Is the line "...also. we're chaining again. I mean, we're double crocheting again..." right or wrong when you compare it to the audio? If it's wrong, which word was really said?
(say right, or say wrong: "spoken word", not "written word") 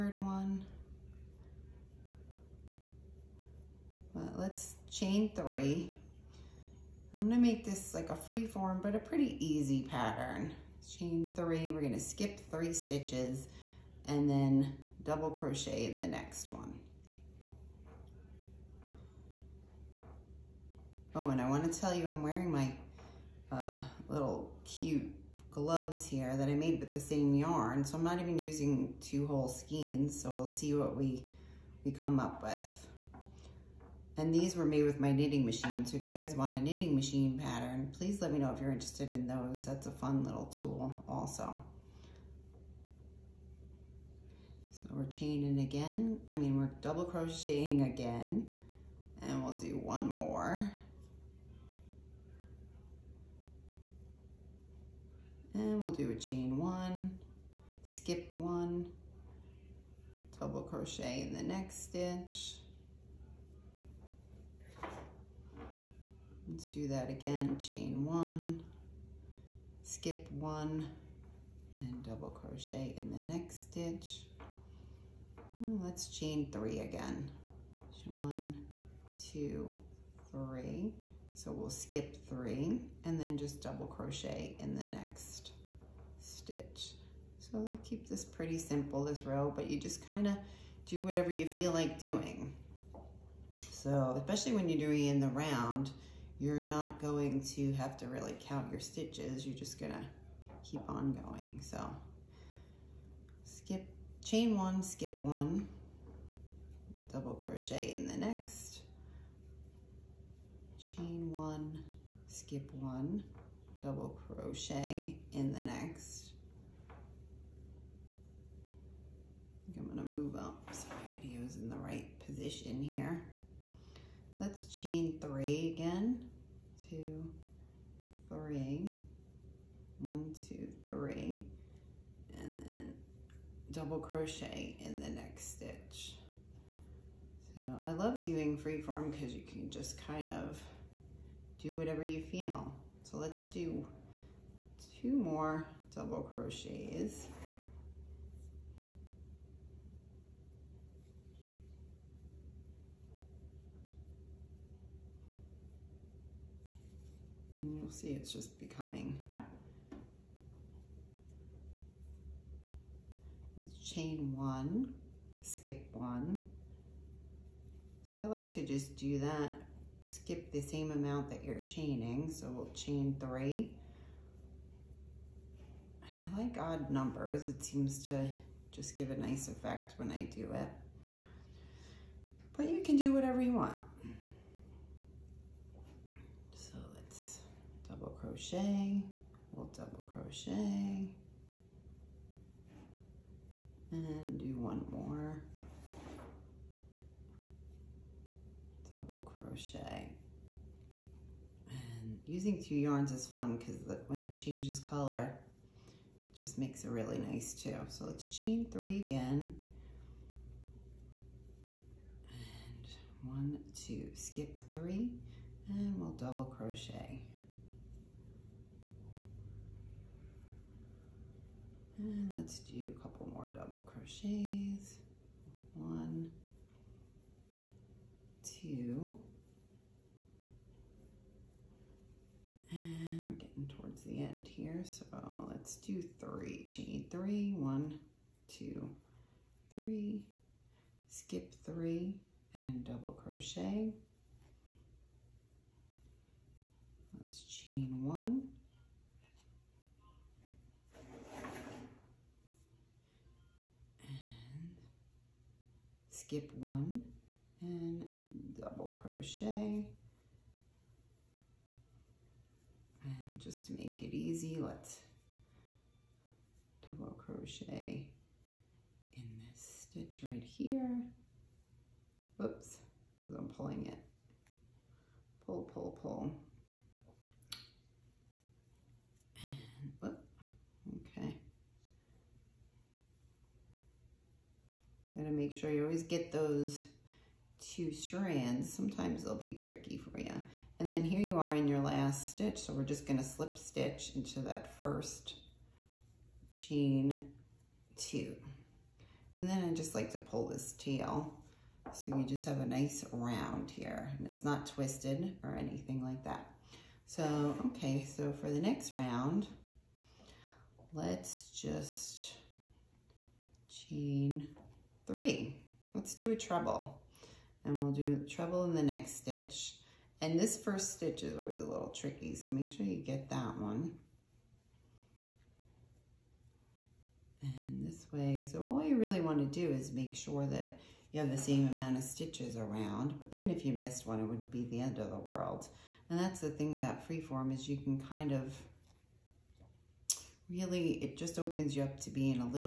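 right.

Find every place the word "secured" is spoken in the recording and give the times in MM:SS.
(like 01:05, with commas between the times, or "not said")
not said.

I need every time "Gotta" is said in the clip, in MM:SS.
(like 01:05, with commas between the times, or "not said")
04:45.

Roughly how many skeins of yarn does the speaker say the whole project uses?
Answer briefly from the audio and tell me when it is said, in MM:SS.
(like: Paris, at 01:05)
2, at 00:29.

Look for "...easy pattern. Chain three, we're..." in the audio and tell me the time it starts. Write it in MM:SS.
00:09.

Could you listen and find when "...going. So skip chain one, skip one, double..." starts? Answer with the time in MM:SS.
01:41.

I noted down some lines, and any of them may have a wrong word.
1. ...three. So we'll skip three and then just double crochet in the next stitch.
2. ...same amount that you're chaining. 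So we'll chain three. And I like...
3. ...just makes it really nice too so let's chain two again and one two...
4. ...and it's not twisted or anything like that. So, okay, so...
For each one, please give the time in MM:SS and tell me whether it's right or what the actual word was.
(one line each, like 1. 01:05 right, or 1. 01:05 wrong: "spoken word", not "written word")
1. 01:20 right
2. 02:50 right
3. 03:26 wrong: "three", not "two"
4. 05:04 right.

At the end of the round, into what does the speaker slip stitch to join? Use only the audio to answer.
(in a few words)
first chain two.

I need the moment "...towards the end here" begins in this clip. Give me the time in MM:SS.
03:53.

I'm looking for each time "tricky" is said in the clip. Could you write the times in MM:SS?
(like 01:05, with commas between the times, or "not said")
04:49, 05:21.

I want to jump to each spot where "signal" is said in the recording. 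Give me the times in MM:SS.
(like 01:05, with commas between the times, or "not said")
not said.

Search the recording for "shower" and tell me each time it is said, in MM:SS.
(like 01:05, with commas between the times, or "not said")
not said.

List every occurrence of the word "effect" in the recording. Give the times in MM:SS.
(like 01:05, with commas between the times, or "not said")
02:59.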